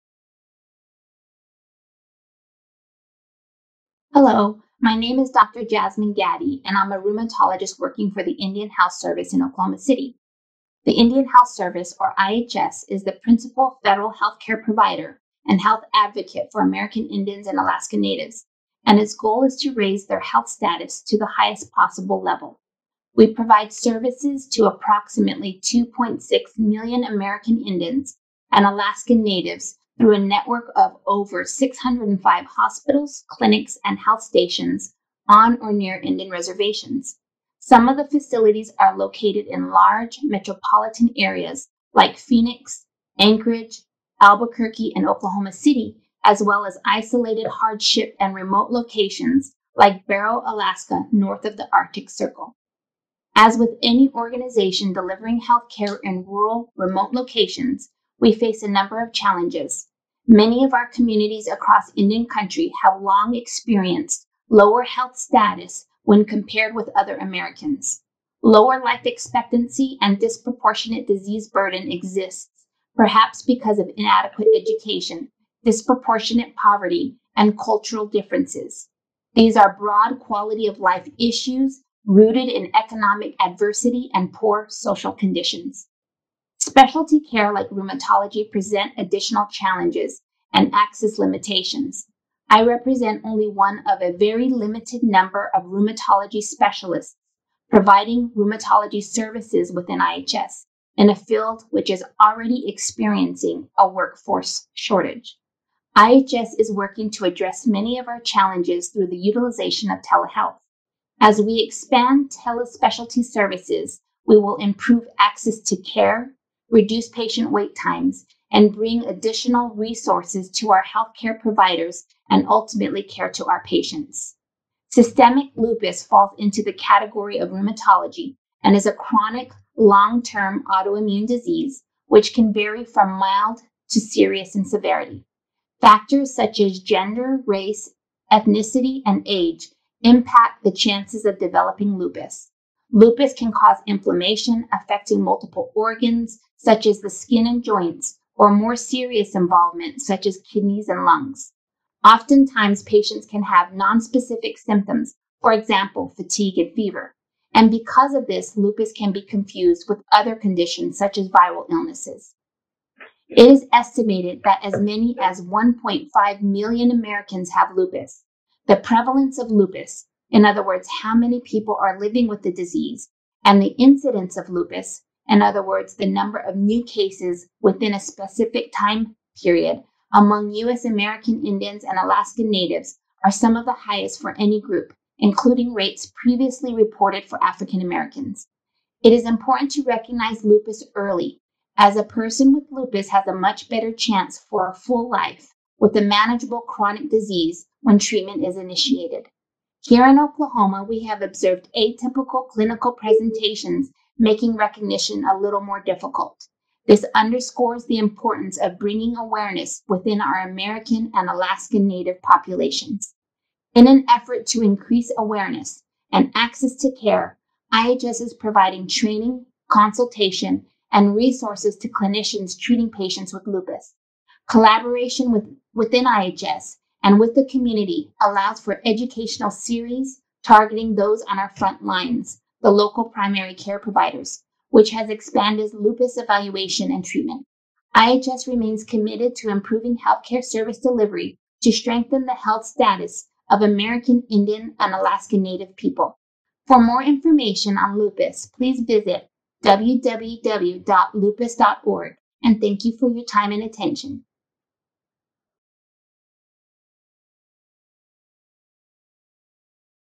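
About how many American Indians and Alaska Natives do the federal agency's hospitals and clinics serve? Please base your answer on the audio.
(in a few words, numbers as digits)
2.6 million.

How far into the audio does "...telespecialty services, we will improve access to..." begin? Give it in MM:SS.
01:52.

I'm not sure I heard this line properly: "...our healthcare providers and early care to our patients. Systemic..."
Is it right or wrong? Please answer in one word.
wrong.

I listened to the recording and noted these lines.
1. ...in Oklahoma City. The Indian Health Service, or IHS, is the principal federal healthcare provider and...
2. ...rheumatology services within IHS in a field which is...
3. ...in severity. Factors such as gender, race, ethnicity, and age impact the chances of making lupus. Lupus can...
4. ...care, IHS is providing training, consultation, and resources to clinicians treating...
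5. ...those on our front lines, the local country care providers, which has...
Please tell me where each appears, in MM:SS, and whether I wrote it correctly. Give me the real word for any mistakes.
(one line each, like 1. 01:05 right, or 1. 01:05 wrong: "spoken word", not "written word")
1. 00:09 right
2. 01:38 right
3. 02:14 wrong: "developing", not "making"
4. 03:36 right
5. 03:50 wrong: "primary", not "country".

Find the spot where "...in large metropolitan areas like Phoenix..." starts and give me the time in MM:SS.
00:39.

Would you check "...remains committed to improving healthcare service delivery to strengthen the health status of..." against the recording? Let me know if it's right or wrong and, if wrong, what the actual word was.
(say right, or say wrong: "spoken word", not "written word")
right.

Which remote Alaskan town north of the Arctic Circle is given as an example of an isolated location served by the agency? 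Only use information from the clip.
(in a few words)
Barrow.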